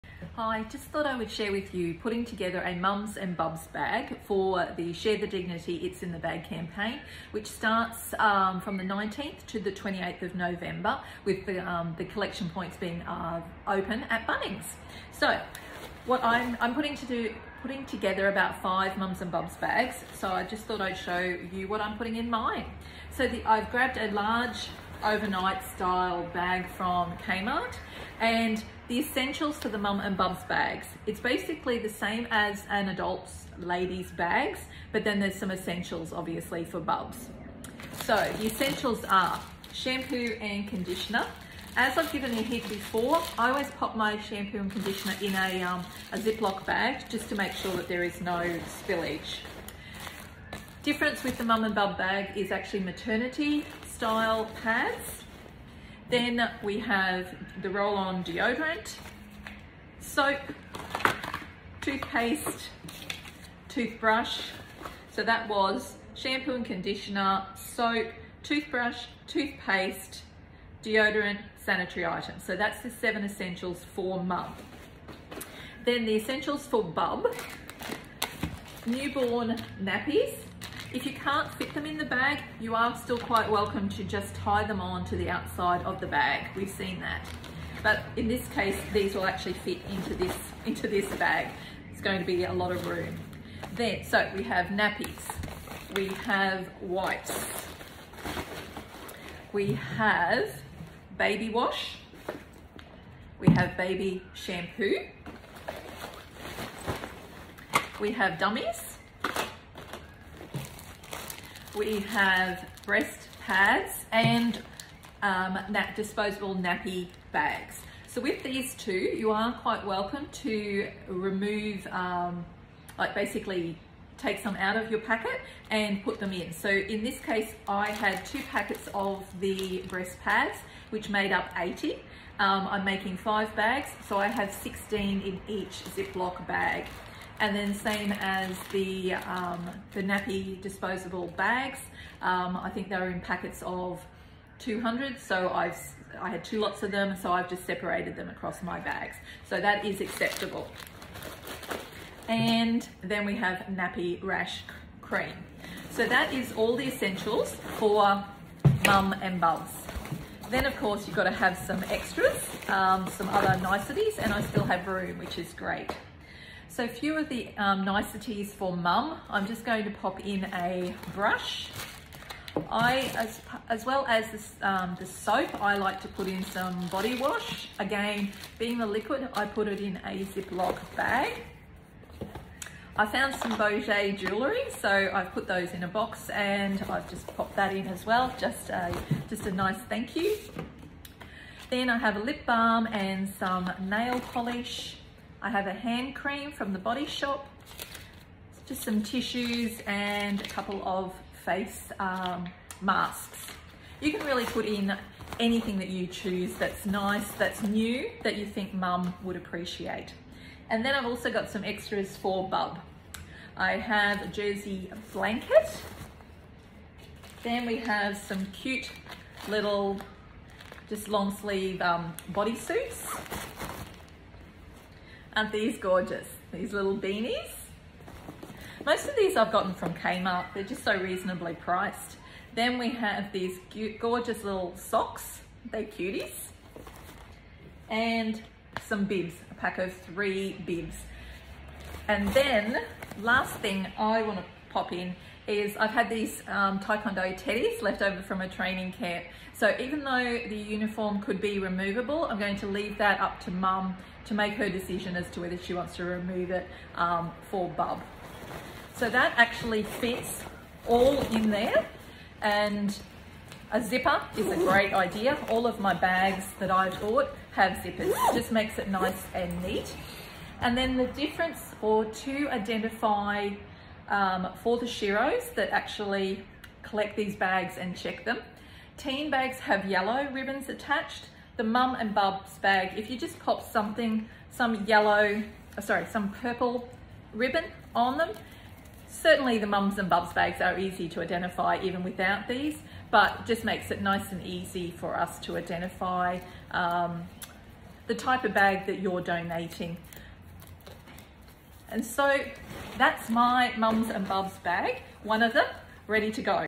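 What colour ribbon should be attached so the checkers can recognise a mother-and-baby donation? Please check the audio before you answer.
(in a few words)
Purple.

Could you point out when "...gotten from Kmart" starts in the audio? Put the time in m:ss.
3:49.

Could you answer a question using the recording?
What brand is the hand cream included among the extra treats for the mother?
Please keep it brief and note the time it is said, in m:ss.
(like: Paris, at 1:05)
The Body Shop, at 3:16.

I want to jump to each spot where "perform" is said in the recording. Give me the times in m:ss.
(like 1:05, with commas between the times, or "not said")
not said.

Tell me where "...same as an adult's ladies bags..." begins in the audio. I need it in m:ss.
0:31.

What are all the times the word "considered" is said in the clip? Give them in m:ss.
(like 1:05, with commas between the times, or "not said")
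not said.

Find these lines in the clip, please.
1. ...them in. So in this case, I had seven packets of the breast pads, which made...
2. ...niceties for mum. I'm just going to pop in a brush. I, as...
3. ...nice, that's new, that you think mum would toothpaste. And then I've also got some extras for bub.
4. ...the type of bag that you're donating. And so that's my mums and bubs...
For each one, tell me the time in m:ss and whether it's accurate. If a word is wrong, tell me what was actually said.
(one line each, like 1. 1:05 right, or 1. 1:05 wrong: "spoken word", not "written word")
1. 2:06 wrong: "two", not "seven"
2. 2:47 right
3. 3:26 wrong: "appreciate", not "toothpaste"
4. 4:58 right.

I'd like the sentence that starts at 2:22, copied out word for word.
Um, I think they were in packets of 200.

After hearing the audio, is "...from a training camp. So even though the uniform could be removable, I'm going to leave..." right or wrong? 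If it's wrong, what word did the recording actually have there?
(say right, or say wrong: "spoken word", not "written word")
right.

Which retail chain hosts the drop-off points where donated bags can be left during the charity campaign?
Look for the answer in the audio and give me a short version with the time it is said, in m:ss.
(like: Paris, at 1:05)
Bunnings, at 0:14.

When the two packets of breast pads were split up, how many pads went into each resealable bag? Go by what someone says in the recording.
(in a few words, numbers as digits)
16.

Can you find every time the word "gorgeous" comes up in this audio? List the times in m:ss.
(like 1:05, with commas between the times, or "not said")
3:45, 3:54.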